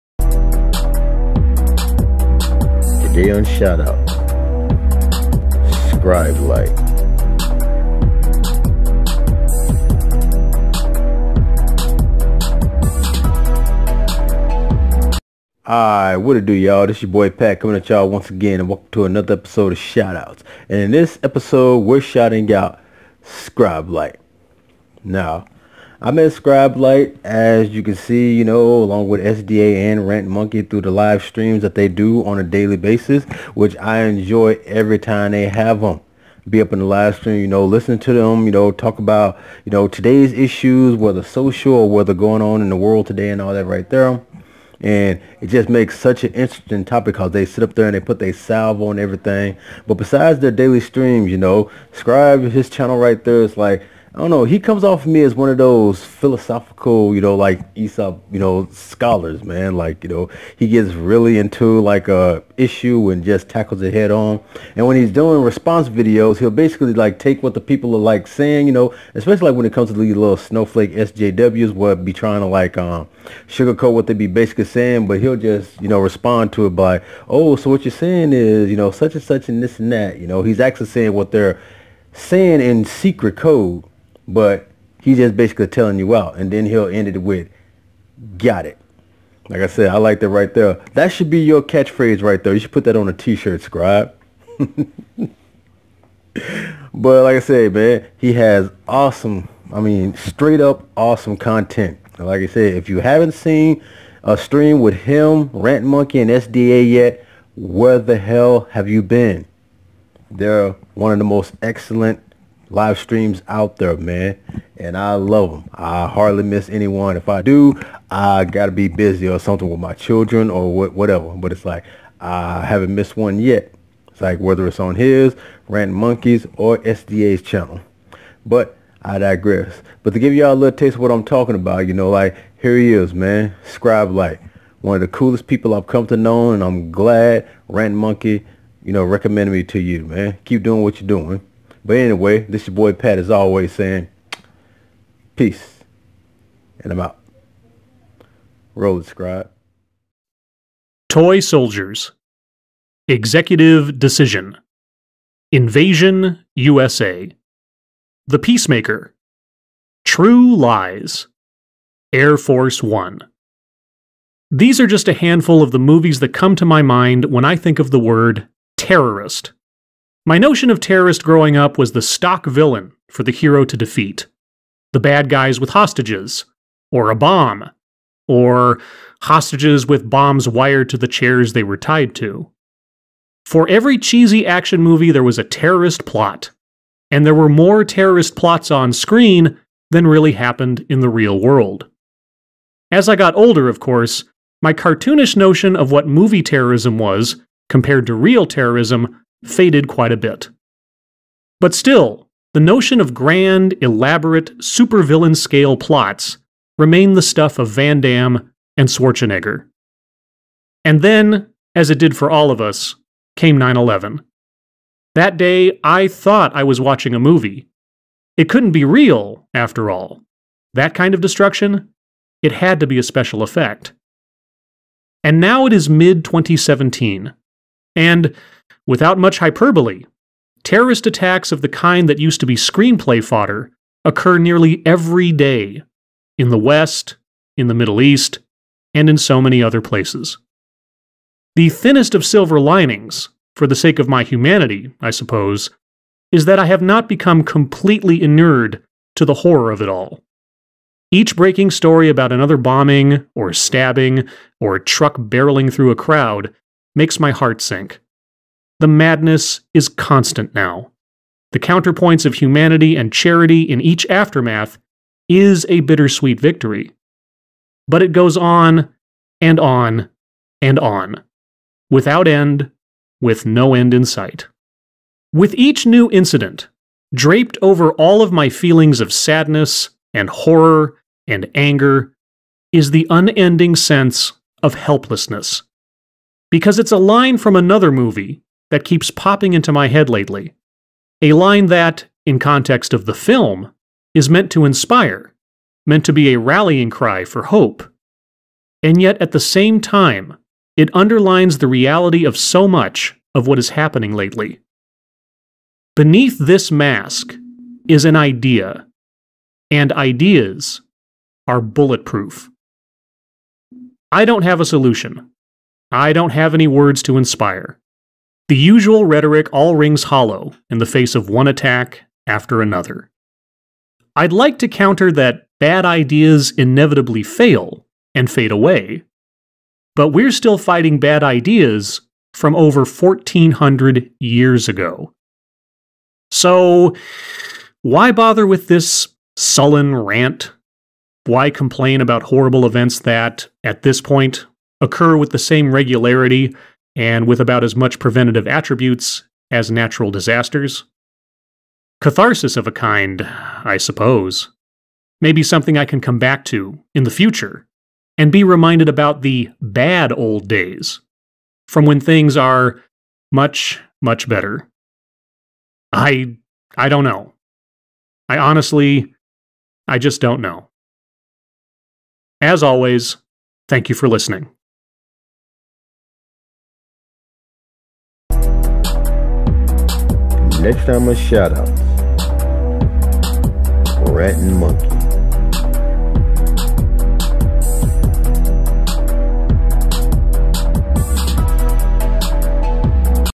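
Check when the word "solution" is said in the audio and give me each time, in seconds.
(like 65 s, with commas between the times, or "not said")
314 s.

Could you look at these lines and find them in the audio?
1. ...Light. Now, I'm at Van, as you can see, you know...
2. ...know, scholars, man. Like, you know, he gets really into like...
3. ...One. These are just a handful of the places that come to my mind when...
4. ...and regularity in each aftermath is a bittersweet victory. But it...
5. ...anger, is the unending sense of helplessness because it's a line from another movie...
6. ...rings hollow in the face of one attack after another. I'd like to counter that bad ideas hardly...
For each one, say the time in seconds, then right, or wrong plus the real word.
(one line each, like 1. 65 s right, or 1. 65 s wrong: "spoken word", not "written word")
1. 23 s wrong: "Light", not "Van"
2. 58 s right
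3. 162 s wrong: "movies", not "places"
4. 262 s wrong: "charity", not "regularity"
5. 281 s right
6. 319 s wrong: "inevitably", not "hardly".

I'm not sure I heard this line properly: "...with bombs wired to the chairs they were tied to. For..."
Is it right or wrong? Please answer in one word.
right.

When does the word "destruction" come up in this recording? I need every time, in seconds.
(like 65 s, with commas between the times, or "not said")
221 s.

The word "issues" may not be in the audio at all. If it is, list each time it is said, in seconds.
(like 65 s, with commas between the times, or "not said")
40 s, 62 s.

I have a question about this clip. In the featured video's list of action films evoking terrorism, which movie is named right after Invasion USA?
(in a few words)
The Peacemaker.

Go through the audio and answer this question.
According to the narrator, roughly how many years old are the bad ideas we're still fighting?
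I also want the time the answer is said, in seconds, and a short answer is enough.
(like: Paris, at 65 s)
1400, at 332 s.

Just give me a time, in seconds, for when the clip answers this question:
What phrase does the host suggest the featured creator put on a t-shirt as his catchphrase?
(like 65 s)
88 s.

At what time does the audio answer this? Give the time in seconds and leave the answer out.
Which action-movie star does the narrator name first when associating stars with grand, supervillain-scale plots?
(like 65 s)
207 s.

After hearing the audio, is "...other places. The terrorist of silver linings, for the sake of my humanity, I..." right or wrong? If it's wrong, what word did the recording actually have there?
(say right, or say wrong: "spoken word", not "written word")
wrong: "thinnest", not "terrorist".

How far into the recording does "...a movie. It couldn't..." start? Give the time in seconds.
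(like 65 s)
217 s.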